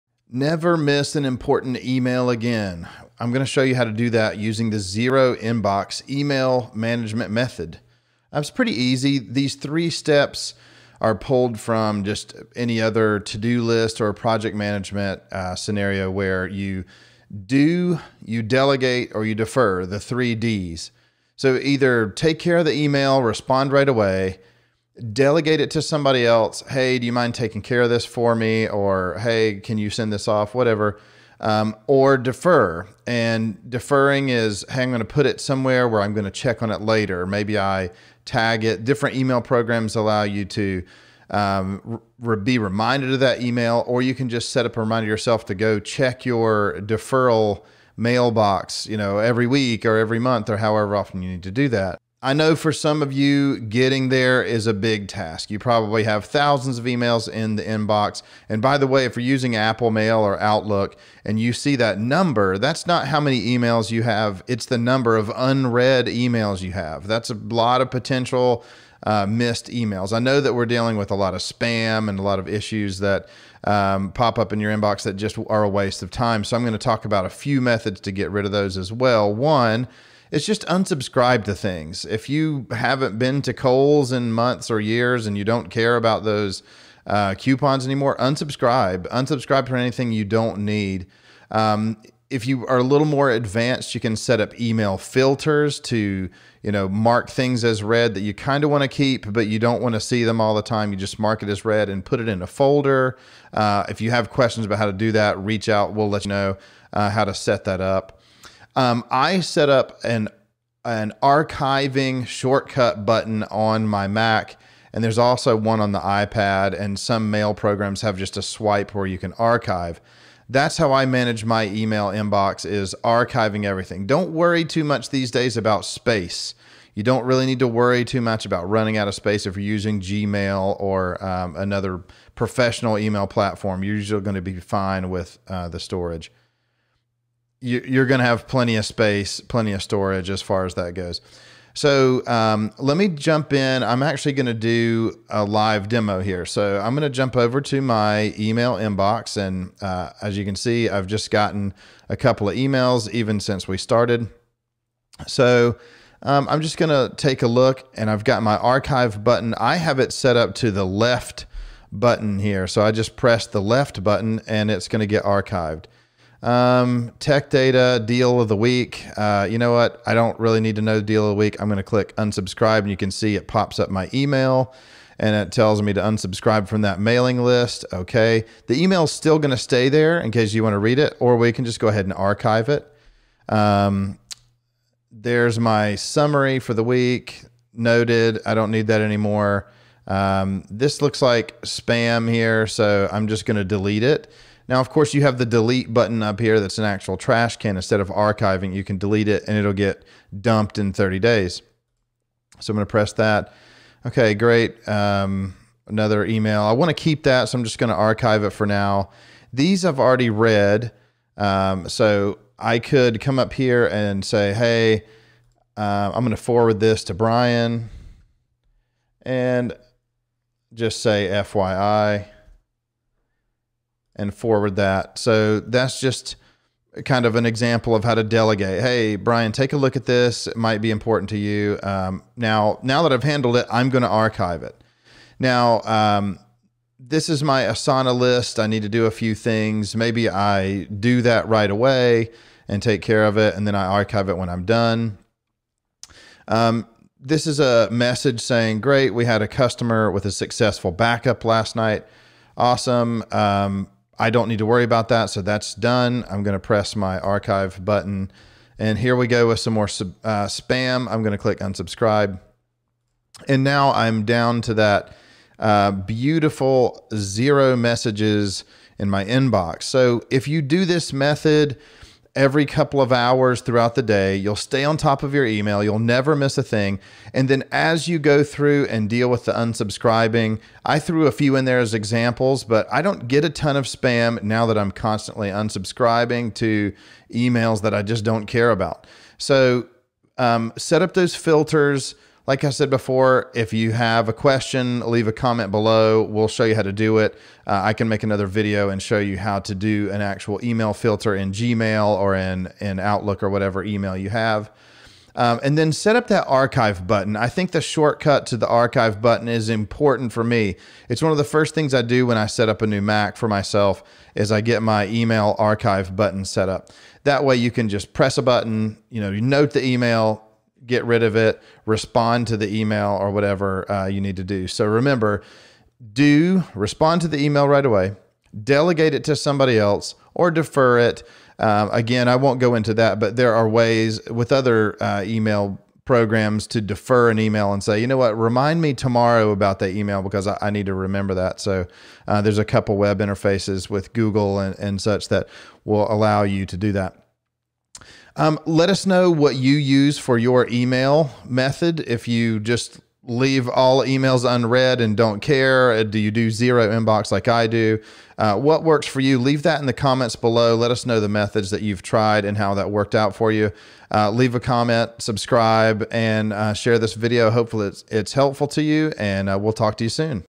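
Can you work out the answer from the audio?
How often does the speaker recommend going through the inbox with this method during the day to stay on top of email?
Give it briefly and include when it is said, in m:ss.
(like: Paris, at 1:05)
Every couple of hours, at 4:32.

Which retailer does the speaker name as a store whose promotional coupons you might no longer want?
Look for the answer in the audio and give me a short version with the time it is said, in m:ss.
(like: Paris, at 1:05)
Kohl's, at 1:23.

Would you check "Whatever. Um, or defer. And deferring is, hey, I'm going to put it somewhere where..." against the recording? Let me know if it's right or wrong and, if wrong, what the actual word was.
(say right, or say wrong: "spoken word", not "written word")
right.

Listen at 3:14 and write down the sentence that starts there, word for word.
Now, of course, you have the delete button up here that's an actual trash can.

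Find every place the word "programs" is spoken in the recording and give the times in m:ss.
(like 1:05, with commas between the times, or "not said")
0:39, 1:57, 5:36.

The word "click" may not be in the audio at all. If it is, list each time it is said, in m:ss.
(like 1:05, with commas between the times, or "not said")
2:51, 4:21.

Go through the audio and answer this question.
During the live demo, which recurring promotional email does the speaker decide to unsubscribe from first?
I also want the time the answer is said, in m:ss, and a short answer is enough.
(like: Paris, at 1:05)
Tech data deal of the week, at 2:47.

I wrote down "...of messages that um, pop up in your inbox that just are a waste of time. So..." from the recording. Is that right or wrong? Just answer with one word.
wrong.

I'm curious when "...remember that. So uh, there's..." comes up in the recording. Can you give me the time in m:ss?
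5:40.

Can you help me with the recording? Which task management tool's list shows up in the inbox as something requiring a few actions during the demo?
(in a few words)
Asana.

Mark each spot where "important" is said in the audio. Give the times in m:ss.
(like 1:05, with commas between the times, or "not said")
0:01, 3:50, 5:09.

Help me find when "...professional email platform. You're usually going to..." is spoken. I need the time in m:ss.
2:12.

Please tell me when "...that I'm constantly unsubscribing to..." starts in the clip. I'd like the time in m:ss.
4:44.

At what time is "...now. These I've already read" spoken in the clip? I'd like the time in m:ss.
3:28.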